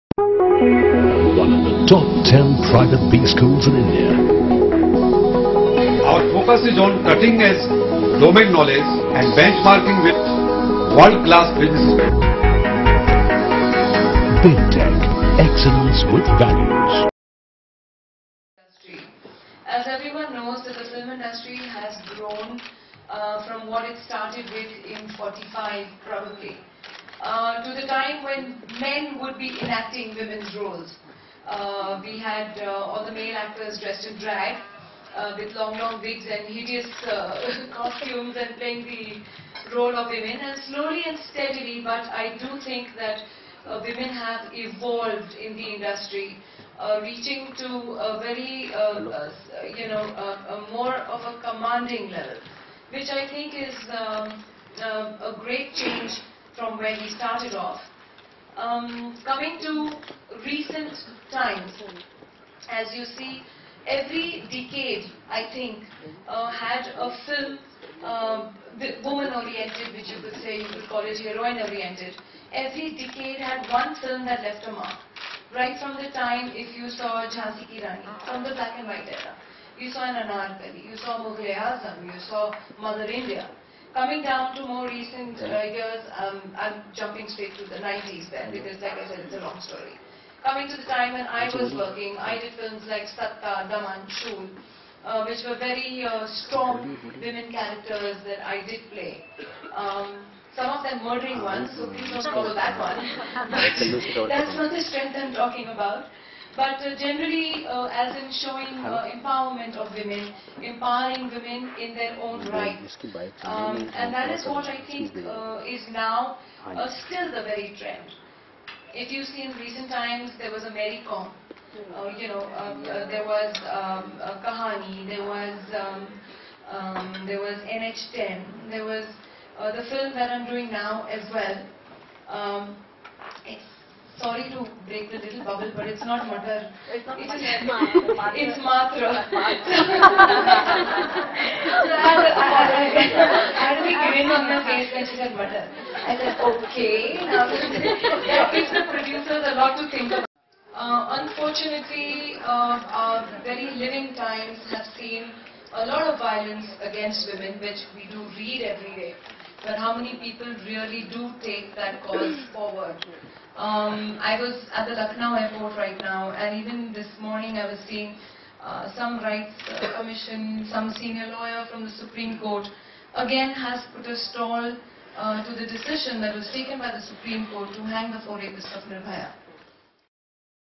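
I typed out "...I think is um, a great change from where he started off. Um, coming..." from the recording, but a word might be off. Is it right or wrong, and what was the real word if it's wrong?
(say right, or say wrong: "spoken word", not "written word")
right.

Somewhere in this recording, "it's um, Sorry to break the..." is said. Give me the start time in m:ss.
2:13.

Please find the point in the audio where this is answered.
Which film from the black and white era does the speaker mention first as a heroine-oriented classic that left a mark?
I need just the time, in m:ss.
1:17.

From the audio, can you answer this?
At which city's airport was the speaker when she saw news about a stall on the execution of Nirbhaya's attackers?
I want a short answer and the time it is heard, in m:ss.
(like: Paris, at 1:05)
Lucknow, at 2:44.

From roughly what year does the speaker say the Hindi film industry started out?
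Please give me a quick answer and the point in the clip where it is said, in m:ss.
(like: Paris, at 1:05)
45, at 0:25.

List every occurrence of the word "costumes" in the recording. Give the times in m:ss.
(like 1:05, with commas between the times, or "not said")
0:37.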